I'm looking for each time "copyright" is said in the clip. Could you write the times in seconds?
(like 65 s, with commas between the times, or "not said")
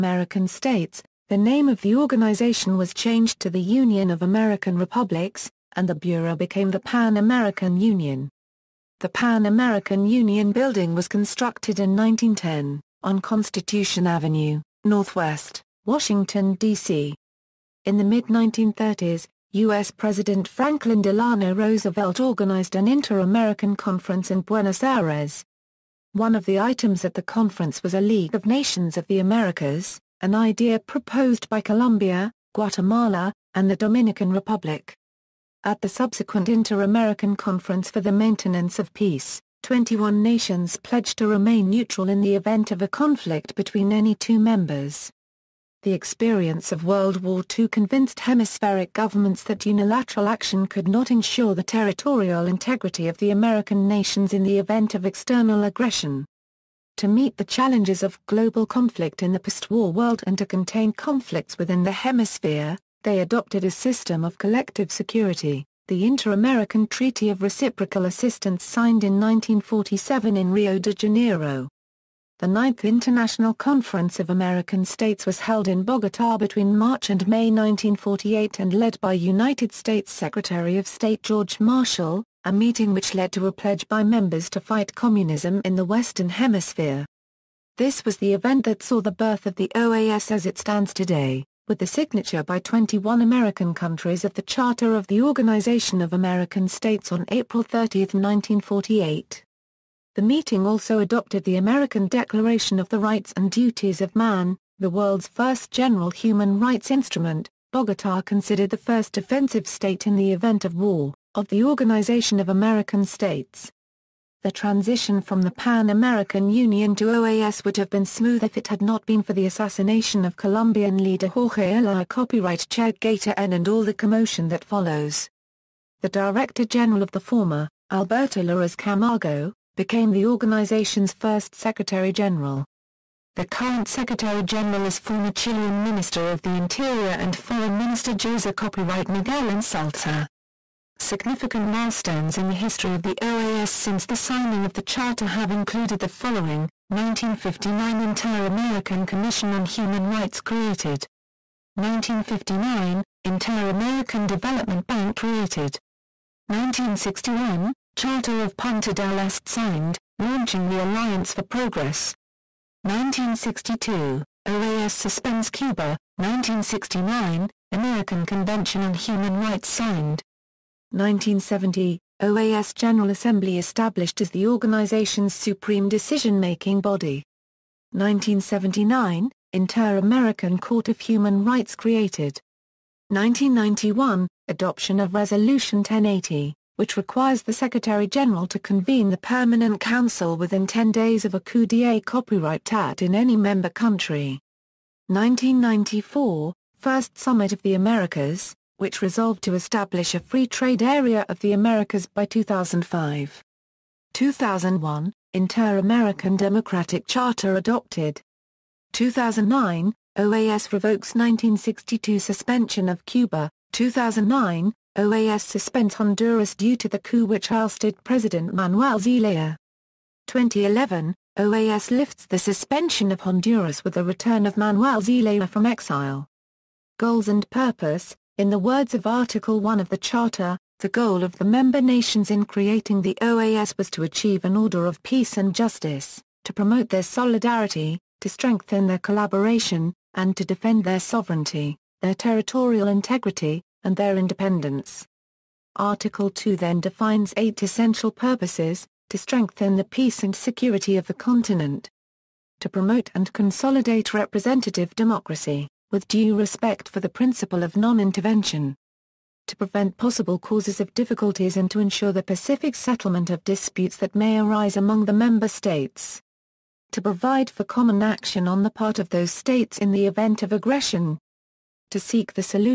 122 s, 138 s, 192 s.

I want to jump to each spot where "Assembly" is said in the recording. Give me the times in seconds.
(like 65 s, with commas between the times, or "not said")
173 s.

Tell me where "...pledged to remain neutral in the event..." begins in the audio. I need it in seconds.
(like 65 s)
40 s.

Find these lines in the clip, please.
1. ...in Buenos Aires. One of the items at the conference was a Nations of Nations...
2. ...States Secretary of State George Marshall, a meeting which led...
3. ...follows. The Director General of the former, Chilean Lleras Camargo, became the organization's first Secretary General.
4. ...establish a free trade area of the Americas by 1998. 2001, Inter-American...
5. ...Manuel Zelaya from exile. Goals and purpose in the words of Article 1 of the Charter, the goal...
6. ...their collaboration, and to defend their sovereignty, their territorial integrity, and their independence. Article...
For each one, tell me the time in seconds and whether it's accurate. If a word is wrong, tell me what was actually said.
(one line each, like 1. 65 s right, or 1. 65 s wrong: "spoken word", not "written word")
1. 24 s wrong: "League", not "Nations"
2. 79 s right
3. 124 s wrong: "Alberto", not "Chilean"
4. 199 s wrong: "2005", not "1998"
5. 224 s right
6. 238 s right.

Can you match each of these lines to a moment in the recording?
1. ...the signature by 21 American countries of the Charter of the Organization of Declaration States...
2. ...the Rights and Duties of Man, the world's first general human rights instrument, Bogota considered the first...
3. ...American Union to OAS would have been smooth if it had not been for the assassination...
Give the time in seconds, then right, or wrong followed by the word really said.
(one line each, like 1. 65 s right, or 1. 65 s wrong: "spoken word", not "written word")
1. 91 s wrong: "American", not "Declaration"
2. 102 s right
3. 115 s right.